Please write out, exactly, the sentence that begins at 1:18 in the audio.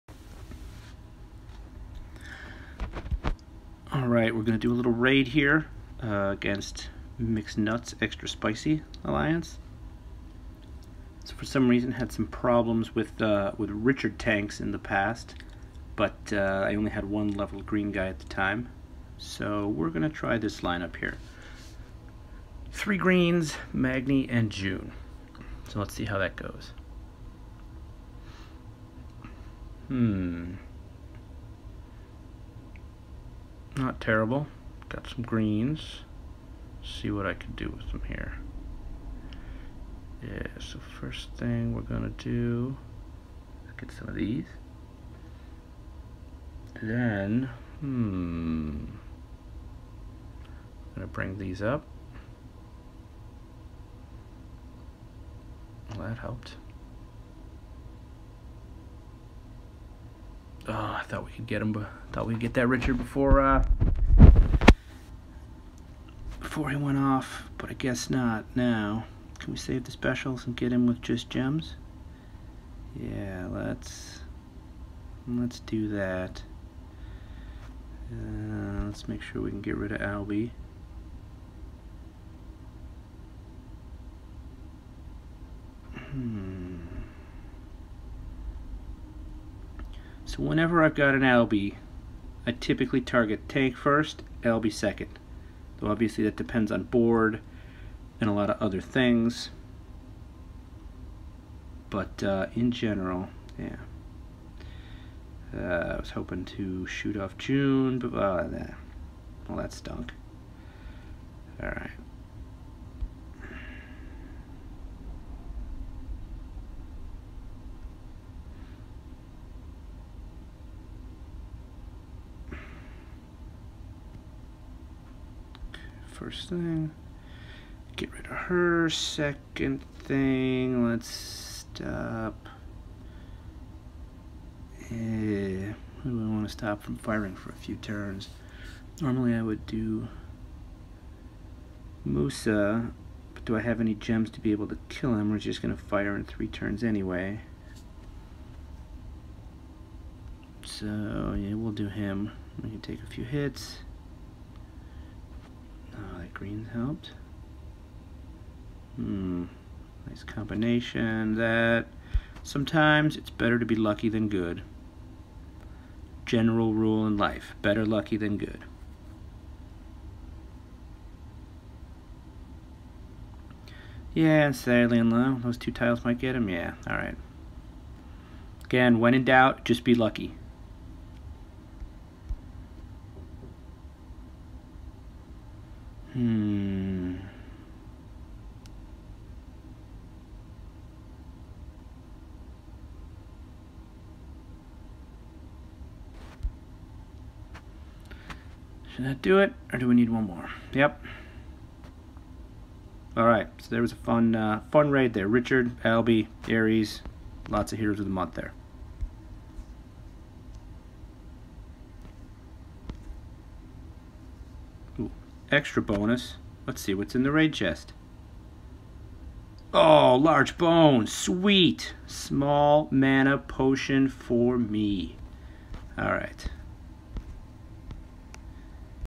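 Uh, let's make sure we can get rid of Albie.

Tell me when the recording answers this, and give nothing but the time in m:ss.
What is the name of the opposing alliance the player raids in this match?
0:07.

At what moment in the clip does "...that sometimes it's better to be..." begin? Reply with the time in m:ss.
2:41.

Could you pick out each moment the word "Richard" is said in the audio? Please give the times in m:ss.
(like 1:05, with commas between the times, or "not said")
0:13, 1:02, 3:25.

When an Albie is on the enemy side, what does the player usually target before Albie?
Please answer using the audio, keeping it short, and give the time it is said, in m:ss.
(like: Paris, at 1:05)
Tank, at 1:33.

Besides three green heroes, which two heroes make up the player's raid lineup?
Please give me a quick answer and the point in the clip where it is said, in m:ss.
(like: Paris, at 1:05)
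Magni and Joon, at 0:23.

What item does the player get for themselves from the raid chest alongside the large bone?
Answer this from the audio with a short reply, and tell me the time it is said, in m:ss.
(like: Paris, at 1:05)
Small mana potion, at 3:42.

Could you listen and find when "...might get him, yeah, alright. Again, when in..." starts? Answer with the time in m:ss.
2:56.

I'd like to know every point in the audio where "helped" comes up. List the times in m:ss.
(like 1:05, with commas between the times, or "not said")
0:56, 2:36.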